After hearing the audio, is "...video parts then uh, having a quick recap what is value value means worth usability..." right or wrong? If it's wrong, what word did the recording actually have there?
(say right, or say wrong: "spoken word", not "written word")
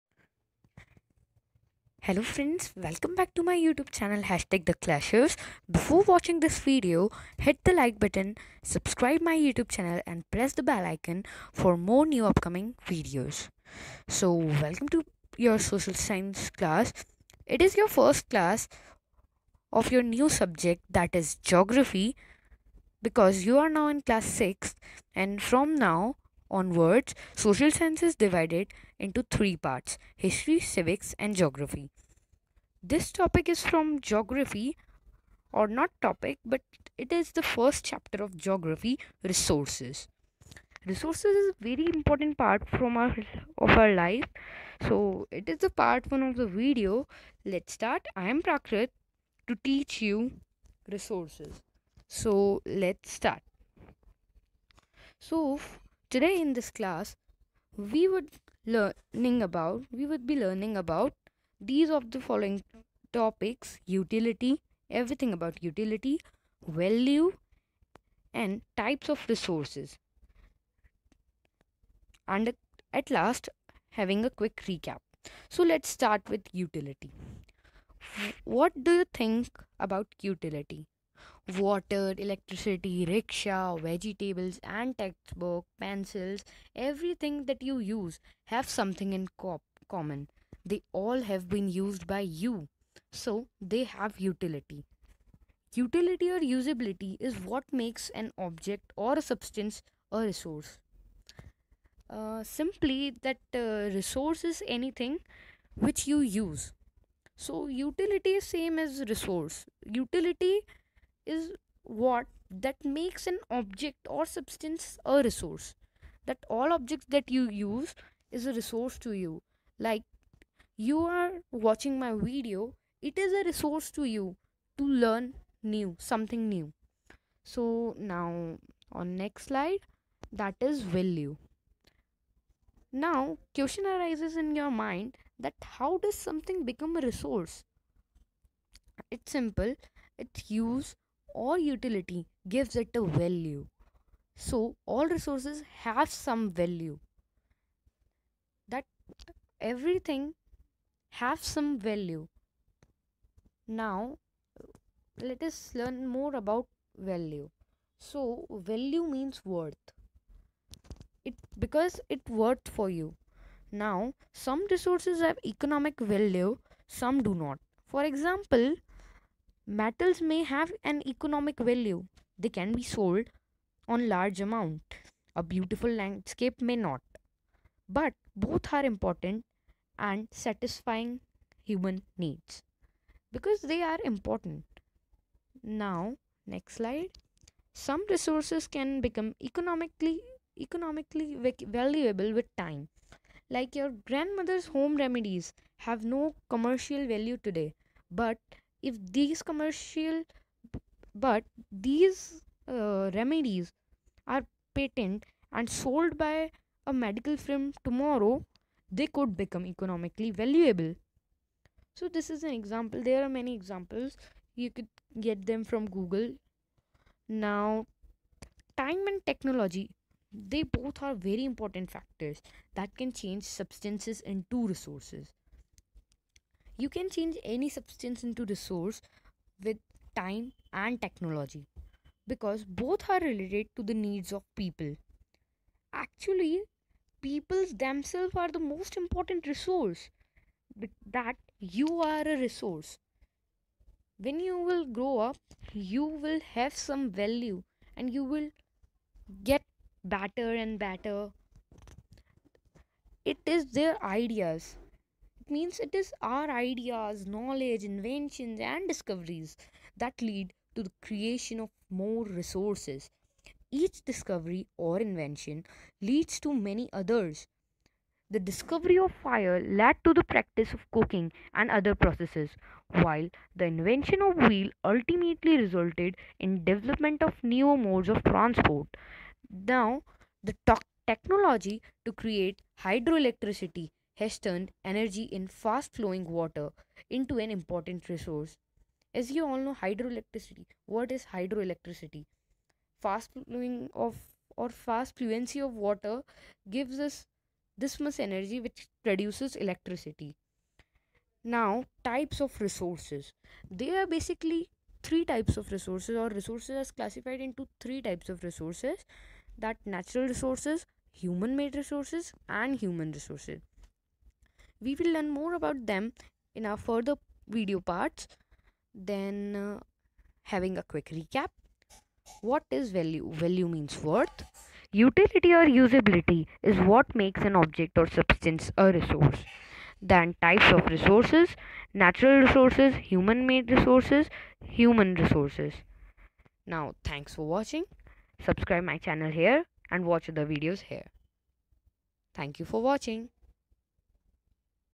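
wrong: "utility", not "usability".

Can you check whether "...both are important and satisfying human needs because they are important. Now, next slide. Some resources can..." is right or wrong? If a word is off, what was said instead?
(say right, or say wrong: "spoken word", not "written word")
right.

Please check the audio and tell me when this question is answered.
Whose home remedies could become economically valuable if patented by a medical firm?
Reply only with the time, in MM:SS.
03:14.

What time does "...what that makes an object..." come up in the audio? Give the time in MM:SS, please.
01:51.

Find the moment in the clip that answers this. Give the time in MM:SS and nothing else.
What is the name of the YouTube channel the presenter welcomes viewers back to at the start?
00:04.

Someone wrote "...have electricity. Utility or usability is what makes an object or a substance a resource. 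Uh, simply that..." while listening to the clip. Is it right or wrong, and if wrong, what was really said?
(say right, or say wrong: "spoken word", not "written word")
wrong: "utility", not "electricity".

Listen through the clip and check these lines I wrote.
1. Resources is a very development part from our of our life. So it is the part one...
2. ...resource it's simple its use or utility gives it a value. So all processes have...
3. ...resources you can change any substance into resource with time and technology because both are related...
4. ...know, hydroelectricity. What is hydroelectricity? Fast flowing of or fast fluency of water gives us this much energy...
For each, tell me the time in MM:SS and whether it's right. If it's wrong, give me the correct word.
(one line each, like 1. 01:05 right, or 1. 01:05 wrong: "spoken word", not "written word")
1. 00:40 wrong: "important", not "development"
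2. 02:17 wrong: "resources", not "processes"
3. 03:44 right
4. 04:49 right.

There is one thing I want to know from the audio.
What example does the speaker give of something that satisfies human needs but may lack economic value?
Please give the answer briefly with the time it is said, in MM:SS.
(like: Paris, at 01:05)
A beautiful landscape, at 02:55.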